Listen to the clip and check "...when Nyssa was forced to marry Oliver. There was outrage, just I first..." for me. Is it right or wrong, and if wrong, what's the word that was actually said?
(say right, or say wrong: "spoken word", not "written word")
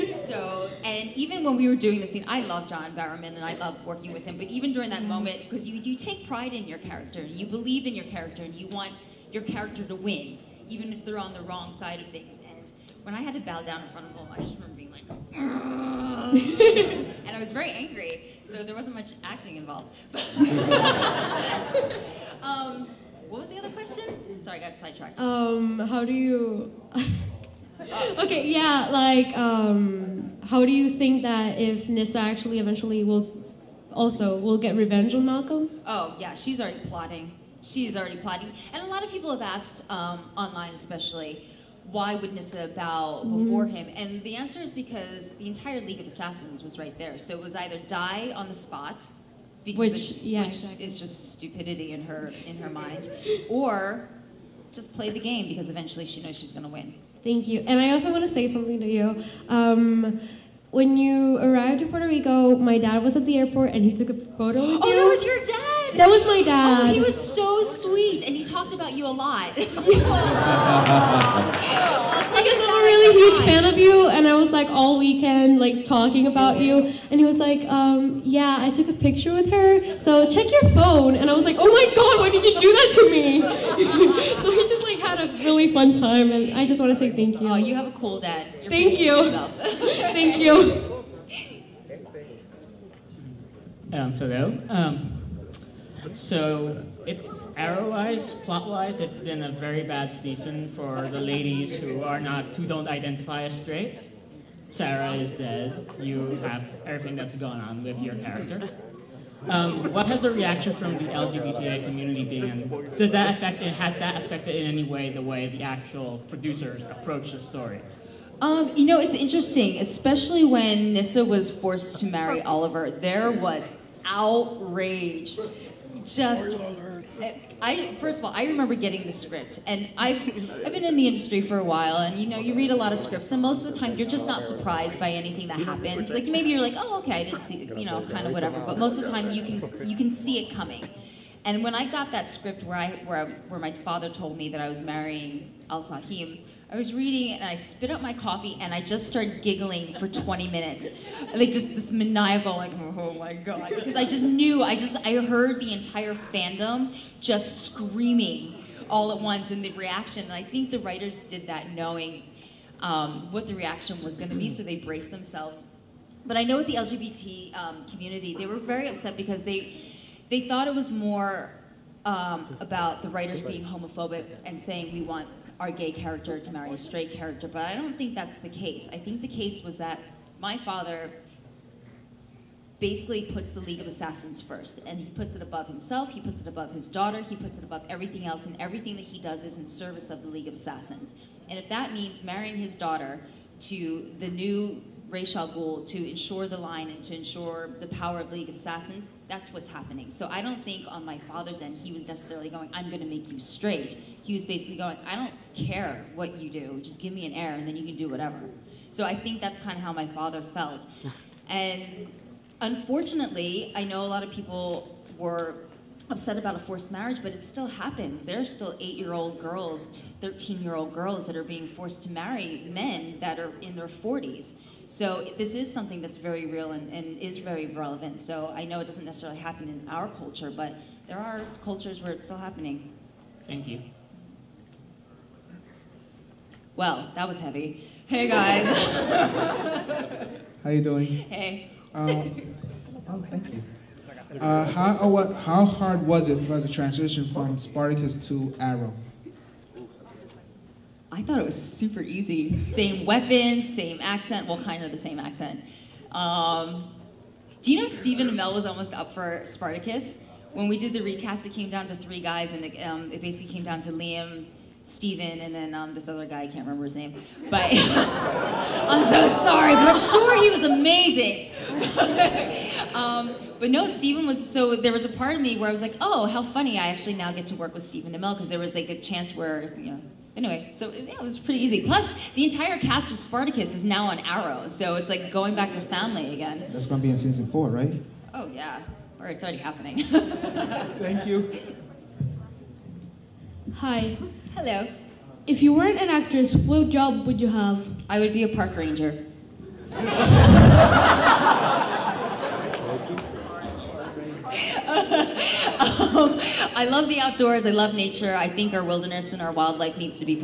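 right.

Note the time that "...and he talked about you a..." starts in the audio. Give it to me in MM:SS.
01:08.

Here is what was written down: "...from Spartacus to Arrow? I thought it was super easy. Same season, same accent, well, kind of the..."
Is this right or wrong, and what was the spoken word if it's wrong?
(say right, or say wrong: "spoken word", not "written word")
wrong: "weapon", not "season".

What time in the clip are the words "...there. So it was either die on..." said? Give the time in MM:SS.
00:46.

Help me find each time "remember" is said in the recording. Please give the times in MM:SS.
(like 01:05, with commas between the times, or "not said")
00:14, 02:08, 04:26.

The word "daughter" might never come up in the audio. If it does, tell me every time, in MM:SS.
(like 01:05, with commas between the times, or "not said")
03:06, 03:12.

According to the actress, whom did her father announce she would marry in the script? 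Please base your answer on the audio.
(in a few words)
Al Sah-him.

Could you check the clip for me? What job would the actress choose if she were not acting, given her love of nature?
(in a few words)
Park ranger.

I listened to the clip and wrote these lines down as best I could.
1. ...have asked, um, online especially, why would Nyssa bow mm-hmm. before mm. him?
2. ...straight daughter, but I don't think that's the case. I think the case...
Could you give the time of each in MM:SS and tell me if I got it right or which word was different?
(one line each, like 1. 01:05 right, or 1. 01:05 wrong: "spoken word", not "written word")
1. 00:39 right
2. 02:56 wrong: "character", not "daughter".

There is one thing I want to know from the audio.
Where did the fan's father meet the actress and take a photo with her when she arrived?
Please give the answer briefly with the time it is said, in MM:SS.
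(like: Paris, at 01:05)
Puerto Rico, at 01:01.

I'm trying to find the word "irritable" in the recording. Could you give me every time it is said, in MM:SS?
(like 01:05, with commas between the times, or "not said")
not said.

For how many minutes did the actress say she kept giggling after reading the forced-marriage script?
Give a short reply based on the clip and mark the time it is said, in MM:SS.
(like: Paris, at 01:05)
20, at 02:30.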